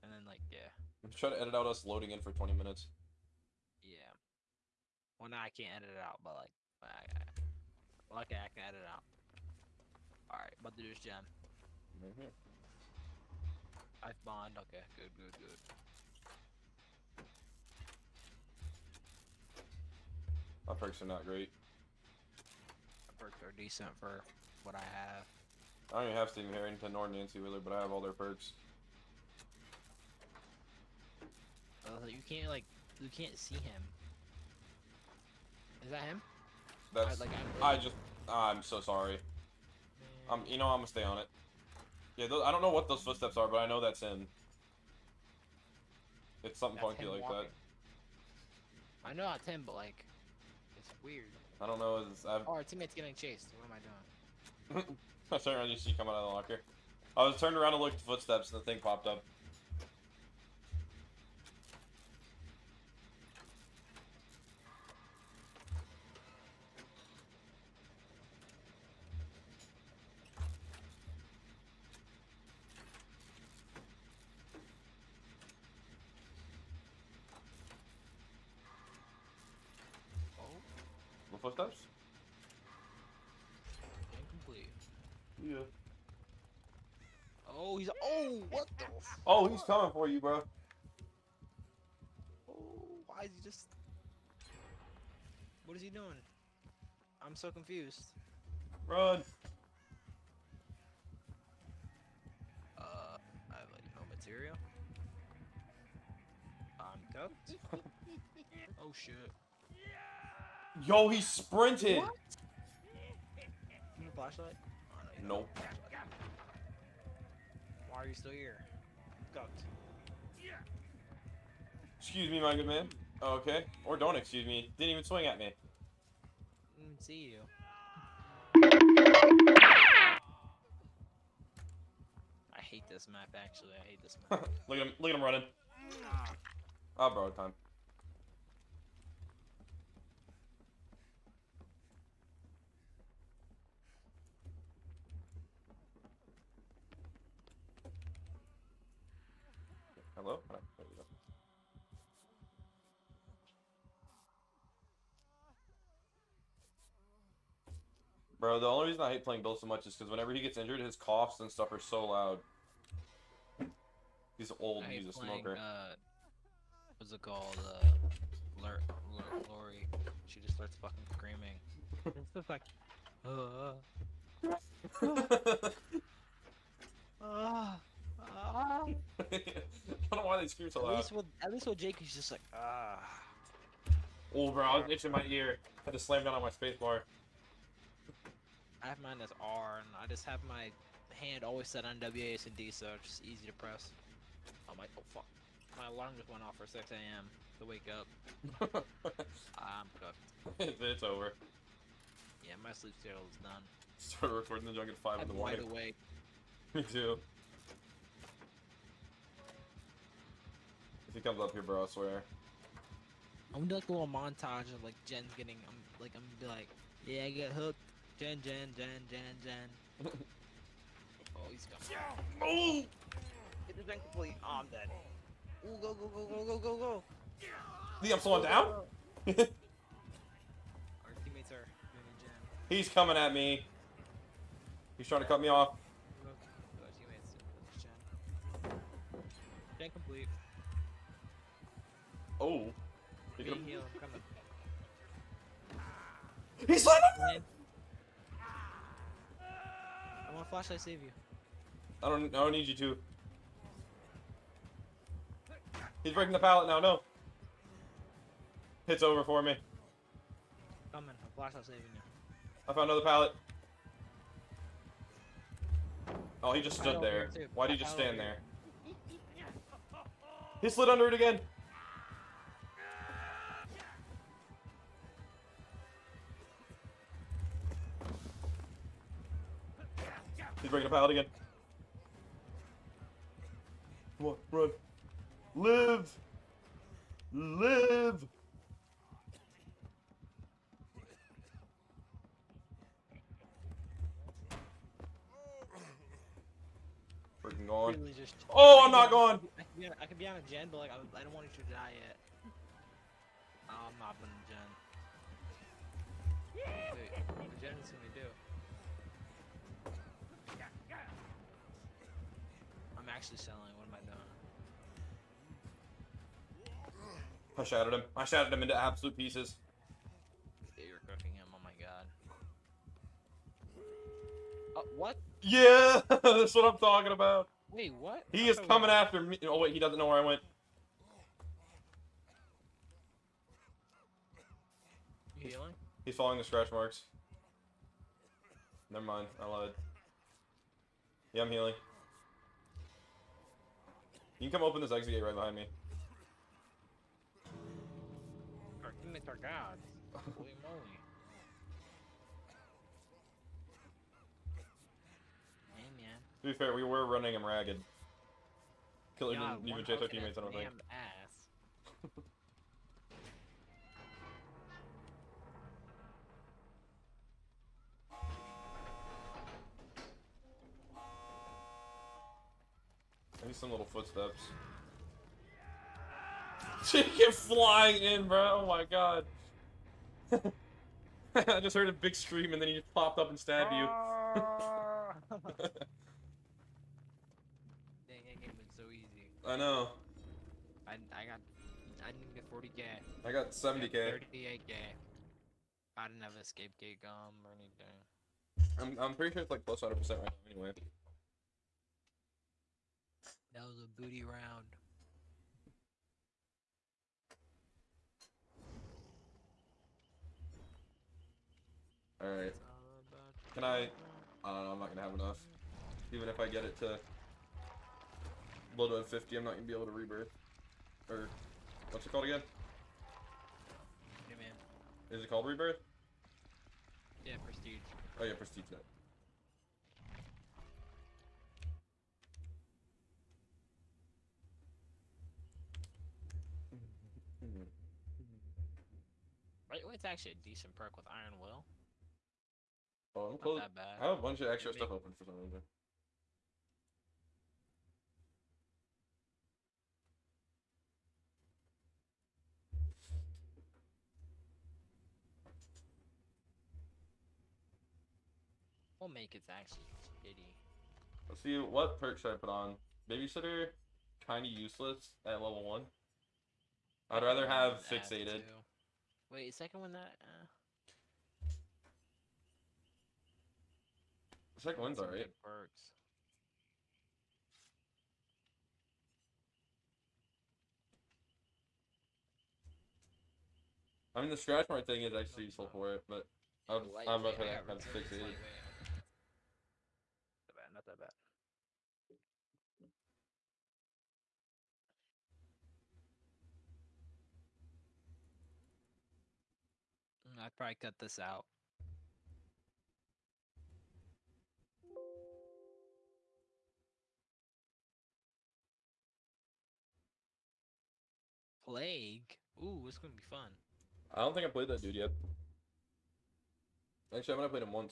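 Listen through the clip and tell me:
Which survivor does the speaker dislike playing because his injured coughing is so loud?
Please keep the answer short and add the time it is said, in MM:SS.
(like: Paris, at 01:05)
Bill, at 02:39.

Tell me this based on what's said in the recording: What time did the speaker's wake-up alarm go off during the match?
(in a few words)
6 a.m.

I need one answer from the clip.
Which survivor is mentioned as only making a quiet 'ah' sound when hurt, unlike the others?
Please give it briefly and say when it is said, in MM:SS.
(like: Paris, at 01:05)
Jake, at 03:01.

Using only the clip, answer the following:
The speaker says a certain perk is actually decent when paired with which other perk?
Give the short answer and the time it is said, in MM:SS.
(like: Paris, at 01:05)
Iron Will, at 07:21.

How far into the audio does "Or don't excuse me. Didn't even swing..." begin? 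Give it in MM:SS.
02:03.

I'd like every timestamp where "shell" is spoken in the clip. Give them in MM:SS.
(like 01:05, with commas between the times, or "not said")
not said.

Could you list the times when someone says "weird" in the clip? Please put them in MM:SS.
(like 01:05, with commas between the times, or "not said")
00:51.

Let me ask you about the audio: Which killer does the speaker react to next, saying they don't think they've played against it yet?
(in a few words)
Plague.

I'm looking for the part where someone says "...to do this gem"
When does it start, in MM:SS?
00:10.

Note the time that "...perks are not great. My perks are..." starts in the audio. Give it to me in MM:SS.
00:20.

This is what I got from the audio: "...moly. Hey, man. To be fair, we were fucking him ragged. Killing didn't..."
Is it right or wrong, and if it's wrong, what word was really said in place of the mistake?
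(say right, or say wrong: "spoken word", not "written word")
wrong: "running", not "fucking".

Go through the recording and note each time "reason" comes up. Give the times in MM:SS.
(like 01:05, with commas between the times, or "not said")
02:38, 07:25.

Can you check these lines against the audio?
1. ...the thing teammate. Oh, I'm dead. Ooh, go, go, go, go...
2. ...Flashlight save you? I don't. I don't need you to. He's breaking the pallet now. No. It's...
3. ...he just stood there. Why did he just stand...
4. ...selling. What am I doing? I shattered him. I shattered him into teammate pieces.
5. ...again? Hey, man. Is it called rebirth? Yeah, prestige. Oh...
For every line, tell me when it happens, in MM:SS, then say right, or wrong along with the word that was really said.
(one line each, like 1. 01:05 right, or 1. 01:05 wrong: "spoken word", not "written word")
1. 03:43 wrong: "complete", not "teammate"
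2. 04:10 right
3. 04:26 right
4. 05:13 wrong: "absolute", not "teammate"
5. 07:02 right.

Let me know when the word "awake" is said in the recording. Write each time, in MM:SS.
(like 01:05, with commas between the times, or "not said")
03:25.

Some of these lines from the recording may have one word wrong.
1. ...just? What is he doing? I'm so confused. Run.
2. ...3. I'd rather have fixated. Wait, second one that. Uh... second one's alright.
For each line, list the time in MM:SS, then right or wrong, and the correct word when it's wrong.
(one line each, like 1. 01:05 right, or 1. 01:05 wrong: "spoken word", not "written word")
1. 01:33 right
2. 07:45 wrong: "1", not "3".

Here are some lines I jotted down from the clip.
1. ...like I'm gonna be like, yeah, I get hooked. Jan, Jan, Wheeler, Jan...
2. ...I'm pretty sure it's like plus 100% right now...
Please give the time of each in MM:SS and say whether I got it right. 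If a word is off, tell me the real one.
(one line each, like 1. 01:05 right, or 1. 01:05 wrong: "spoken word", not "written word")
1. 03:35 wrong: "Jan", not "Wheeler"
2. 06:39 right.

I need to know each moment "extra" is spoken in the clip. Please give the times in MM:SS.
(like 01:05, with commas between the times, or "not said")
07:24.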